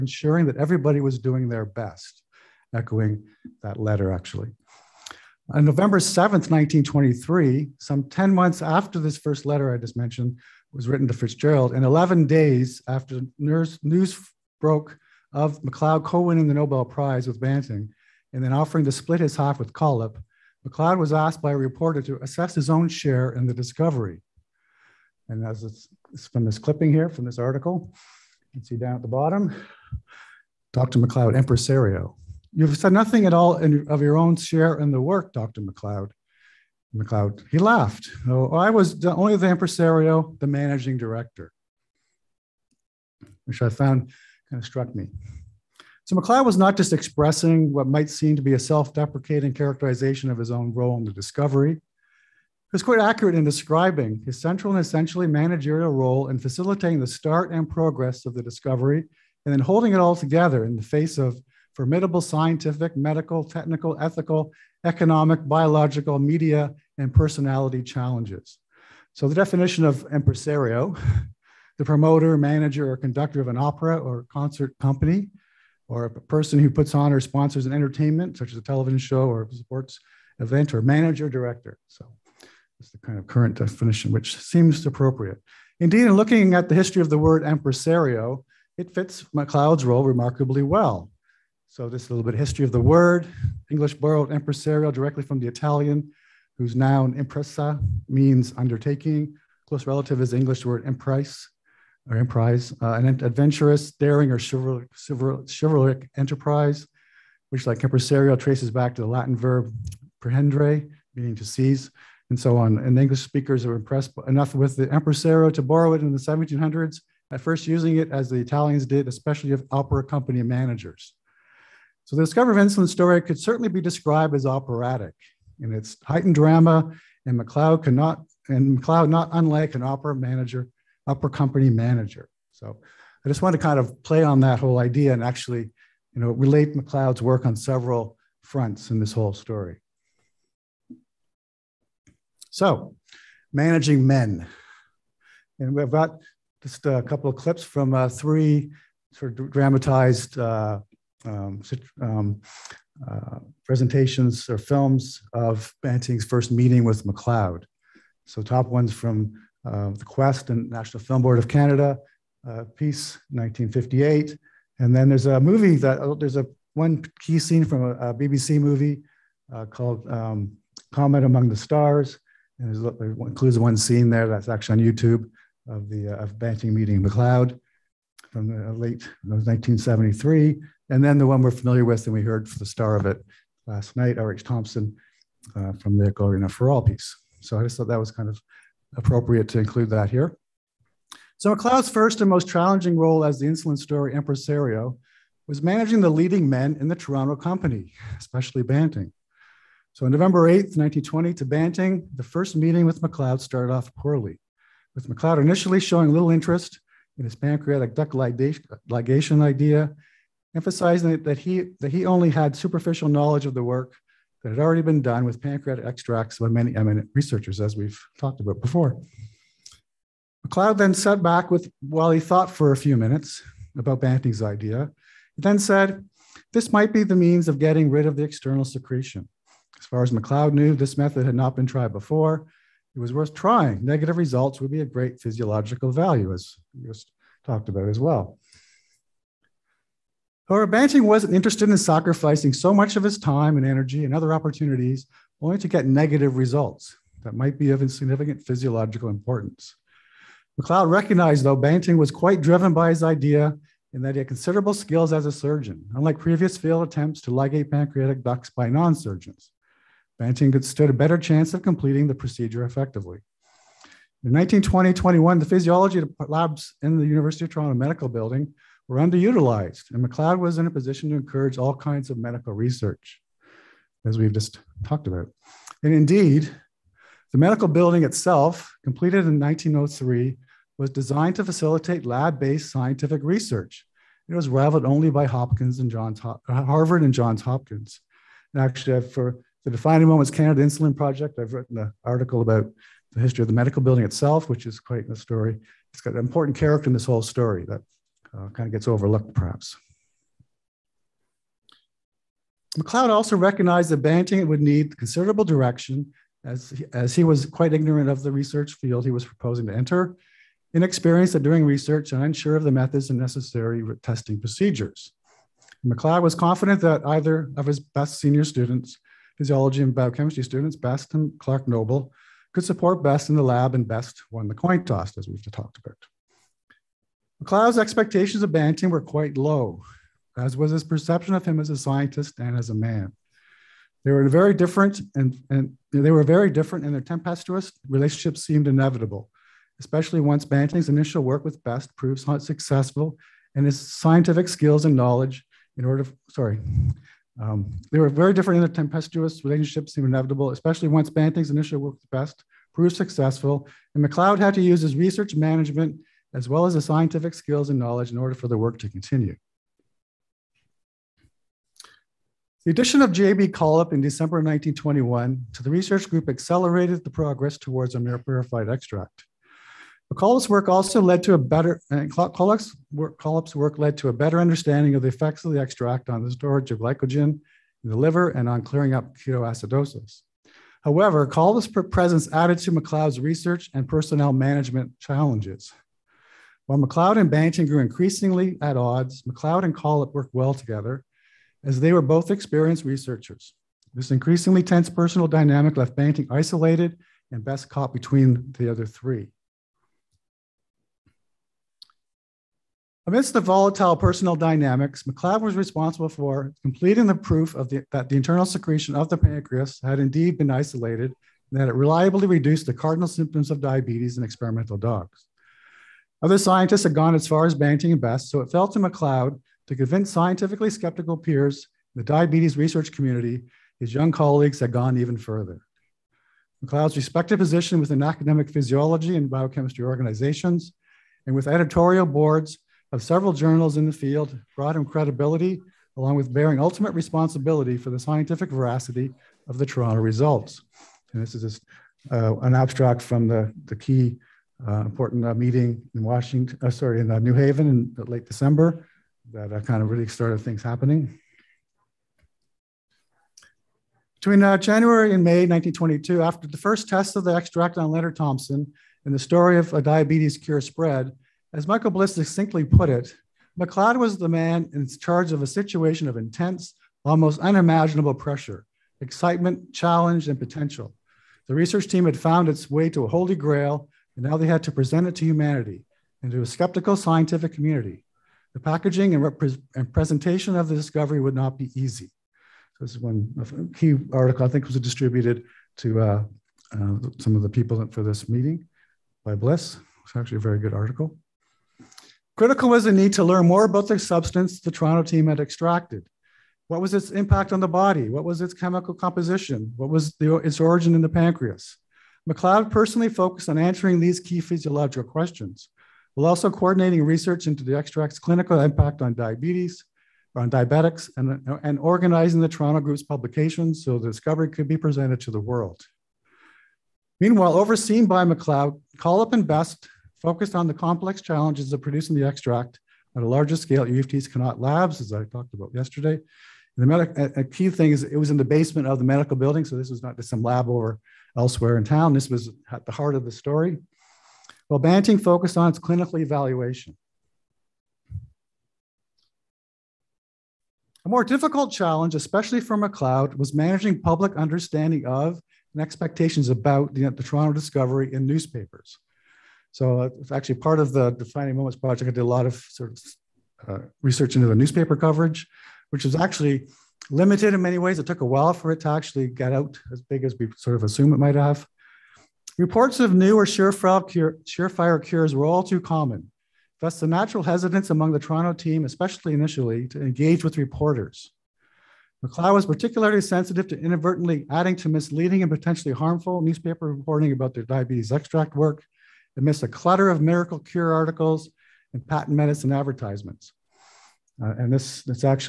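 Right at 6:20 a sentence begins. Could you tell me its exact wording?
However, Collip's presence added to McLeod's research and personnel management challenges.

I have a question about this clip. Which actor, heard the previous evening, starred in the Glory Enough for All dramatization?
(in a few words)
R.H. Thompson.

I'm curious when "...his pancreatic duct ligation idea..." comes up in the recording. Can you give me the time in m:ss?
3:27.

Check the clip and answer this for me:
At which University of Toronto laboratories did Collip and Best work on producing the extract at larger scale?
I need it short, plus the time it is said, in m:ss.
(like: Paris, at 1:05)
Connaught Labs, at 8:44.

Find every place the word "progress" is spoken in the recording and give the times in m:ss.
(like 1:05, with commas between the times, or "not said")
0:57, 6:07.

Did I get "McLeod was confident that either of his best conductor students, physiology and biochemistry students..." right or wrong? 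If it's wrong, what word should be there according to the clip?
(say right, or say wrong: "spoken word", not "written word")
wrong: "senior", not "conductor".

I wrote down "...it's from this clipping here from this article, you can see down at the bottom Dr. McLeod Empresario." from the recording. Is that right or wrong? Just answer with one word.
right.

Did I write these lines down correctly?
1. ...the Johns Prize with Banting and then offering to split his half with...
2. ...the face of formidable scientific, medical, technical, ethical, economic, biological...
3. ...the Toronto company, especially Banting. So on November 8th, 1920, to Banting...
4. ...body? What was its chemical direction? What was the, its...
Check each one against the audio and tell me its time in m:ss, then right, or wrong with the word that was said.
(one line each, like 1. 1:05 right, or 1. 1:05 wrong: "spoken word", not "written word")
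1. 0:16 wrong: "Nobel", not "Johns"
2. 1:00 right
3. 3:16 right
4. 8:17 wrong: "composition", not "direction".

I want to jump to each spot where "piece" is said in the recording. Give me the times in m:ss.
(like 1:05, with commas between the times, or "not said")
2:42, 3:06.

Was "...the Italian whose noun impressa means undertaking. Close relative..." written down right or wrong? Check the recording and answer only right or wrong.
right.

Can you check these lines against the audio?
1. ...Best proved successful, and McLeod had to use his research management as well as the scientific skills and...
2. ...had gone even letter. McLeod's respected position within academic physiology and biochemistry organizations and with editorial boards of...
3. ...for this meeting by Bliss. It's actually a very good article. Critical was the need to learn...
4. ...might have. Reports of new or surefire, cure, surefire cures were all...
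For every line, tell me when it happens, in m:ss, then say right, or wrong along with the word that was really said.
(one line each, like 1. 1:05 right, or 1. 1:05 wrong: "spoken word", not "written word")
1. 5:52 right
2. 7:04 wrong: "further", not "letter"
3. 8:07 right
4. 9:21 right.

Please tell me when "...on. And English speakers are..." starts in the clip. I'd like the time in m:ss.
1:52.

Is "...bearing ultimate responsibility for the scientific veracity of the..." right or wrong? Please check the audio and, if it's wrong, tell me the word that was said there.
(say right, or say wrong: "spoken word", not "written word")
right.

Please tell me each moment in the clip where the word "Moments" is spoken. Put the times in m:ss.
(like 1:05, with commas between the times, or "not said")
4:50, 9:11.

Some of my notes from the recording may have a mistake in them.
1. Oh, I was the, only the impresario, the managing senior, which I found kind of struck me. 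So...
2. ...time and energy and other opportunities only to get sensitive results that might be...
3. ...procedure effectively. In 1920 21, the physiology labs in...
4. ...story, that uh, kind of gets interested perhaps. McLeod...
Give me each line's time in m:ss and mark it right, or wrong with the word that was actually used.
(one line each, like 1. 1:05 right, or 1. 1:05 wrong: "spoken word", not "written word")
1. 0:38 wrong: "director", not "senior"
2. 4:03 wrong: "negative", not "sensitive"
3. 4:22 right
4. 4:57 wrong: "overlooked", not "interested".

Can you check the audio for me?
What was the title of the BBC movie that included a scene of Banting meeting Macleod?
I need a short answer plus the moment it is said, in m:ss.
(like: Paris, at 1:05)
Comet Among the Stars, at 2:50.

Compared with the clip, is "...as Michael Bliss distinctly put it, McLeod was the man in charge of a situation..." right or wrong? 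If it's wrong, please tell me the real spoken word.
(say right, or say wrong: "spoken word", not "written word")
right.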